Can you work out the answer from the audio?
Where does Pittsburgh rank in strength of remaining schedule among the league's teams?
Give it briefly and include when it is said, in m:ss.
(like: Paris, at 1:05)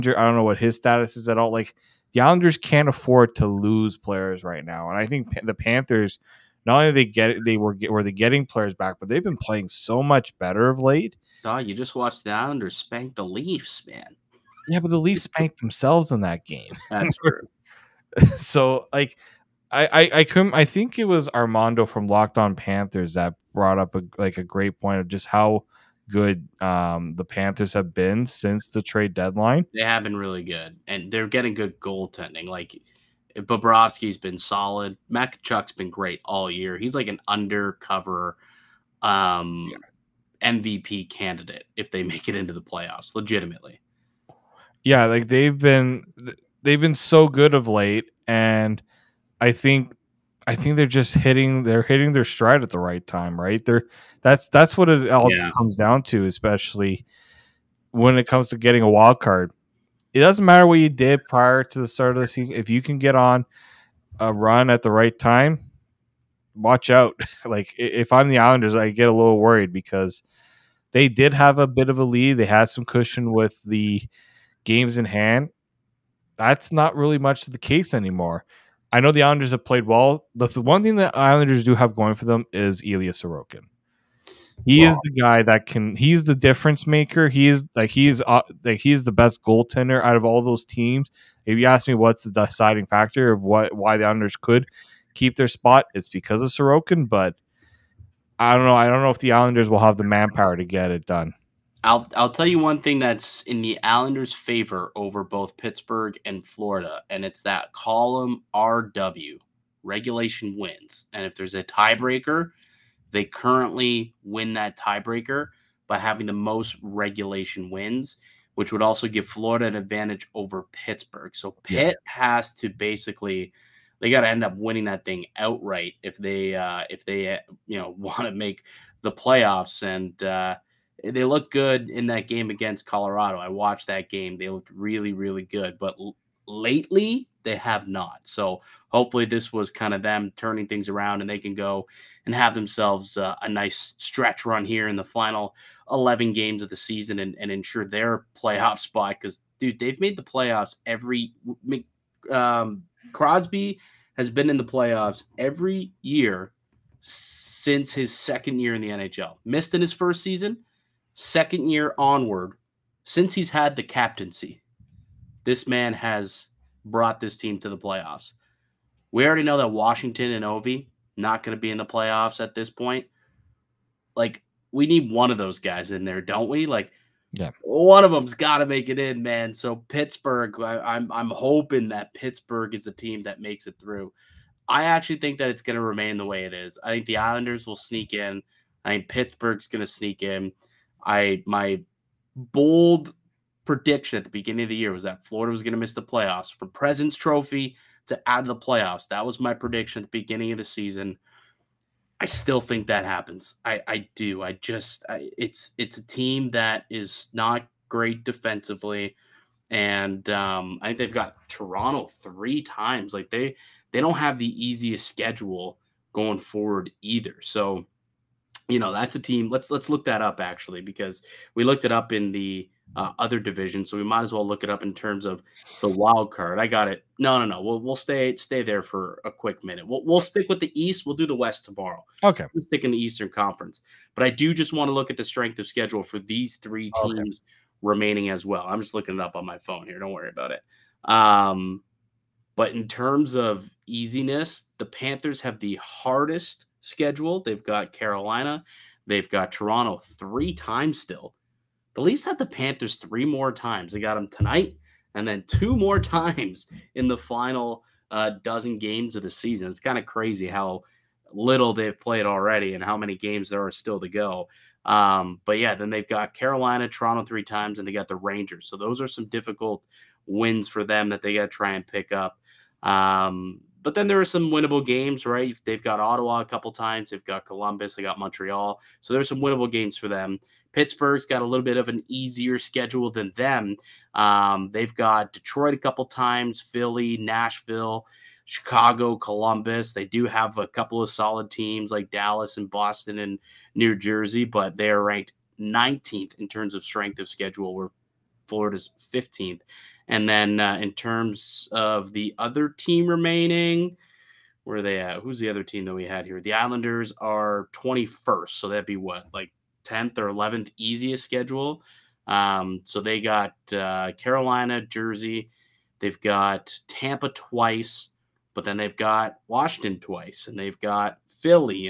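19th, at 4:55.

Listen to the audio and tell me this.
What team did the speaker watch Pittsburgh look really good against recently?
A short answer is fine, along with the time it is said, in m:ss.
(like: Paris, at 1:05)
Colorado, at 2:12.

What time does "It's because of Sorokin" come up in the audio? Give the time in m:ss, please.
1:35.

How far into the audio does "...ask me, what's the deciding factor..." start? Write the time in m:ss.
1:31.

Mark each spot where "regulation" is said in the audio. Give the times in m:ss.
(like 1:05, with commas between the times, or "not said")
1:49, 1:56.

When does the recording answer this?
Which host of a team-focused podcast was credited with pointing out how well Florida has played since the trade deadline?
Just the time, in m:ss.
0:21.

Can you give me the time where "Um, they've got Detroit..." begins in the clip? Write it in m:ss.
4:44.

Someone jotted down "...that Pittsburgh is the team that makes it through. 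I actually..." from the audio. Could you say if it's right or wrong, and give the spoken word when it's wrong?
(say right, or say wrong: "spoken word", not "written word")
right.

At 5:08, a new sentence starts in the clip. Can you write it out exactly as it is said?
So that'd be what, like 10th or 11th easiest schedule?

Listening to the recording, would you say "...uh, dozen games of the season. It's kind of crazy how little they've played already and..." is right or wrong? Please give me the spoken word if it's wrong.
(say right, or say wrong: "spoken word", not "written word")
right.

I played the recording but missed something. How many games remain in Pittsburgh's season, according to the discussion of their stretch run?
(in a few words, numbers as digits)
11.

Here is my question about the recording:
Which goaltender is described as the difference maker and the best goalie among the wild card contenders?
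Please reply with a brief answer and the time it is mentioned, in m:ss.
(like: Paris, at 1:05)
Ilya Sorokin, at 1:22.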